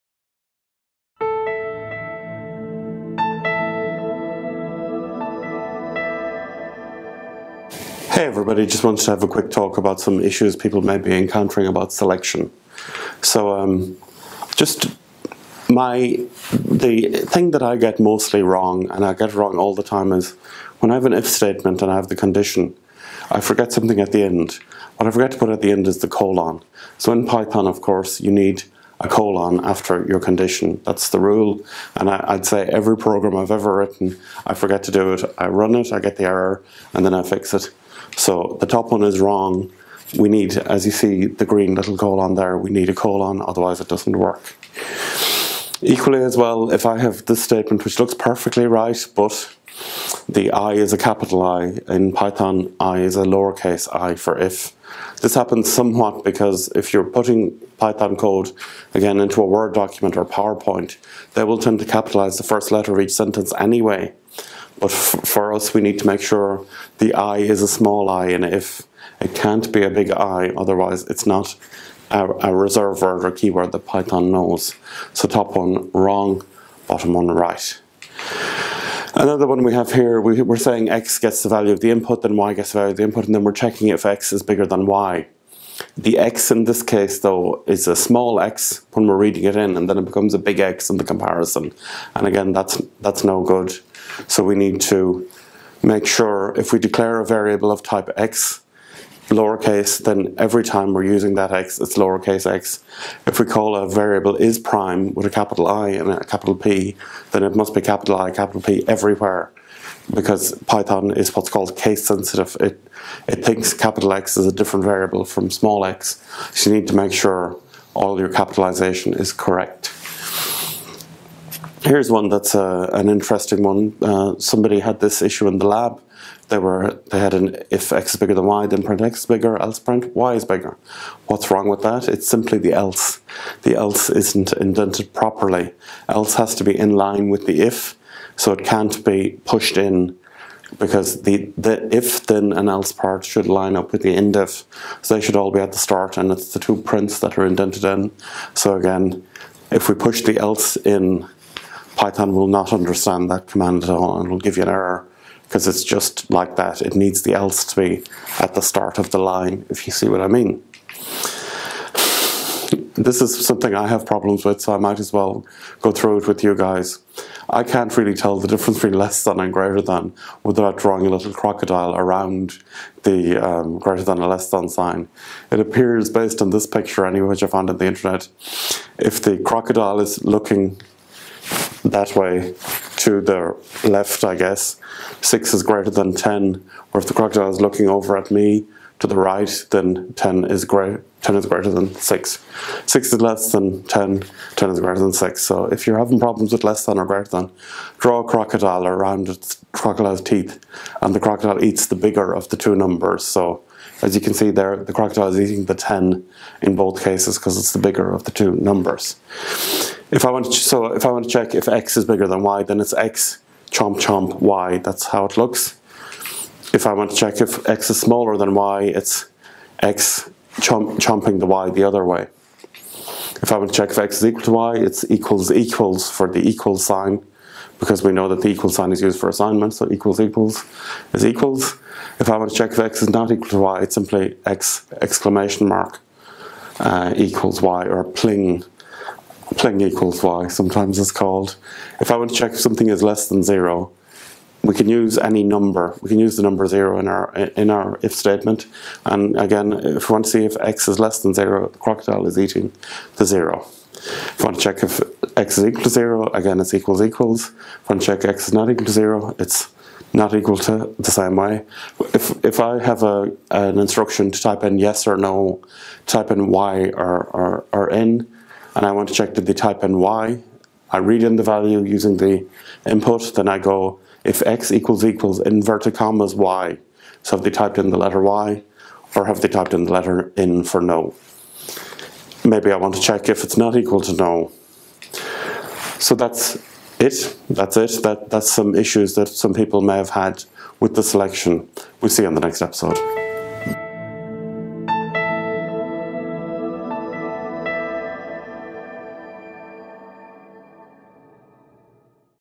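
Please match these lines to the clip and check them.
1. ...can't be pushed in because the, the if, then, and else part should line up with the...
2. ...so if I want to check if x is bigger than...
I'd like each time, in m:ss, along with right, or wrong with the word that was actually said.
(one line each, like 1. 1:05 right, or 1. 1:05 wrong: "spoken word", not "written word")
1. 2:18 right
2. 3:30 right.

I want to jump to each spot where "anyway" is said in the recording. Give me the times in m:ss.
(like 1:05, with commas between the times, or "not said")
1:03, 2:57.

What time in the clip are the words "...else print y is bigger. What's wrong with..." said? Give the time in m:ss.
2:09.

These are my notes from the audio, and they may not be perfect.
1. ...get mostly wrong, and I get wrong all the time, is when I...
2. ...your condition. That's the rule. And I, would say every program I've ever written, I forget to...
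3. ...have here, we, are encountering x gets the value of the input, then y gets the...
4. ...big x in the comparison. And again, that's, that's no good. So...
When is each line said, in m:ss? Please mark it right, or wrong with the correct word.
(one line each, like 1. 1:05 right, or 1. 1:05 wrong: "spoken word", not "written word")
1. 0:17 right
2. 0:30 right
3. 1:19 wrong: "saying", not "encountering"
4. 1:30 right.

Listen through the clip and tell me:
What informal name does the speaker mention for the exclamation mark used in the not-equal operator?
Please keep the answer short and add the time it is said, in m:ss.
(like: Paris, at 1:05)
pling, at 3:58.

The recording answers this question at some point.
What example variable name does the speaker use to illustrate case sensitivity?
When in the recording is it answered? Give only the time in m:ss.
1:44.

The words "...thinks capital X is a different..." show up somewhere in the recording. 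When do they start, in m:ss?
1:53.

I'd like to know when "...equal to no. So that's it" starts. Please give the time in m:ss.
4:43.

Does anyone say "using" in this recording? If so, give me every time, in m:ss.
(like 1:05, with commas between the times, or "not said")
1:41, 4:31.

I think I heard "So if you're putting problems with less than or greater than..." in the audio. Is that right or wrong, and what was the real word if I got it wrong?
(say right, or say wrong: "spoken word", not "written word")
wrong: "having", not "putting".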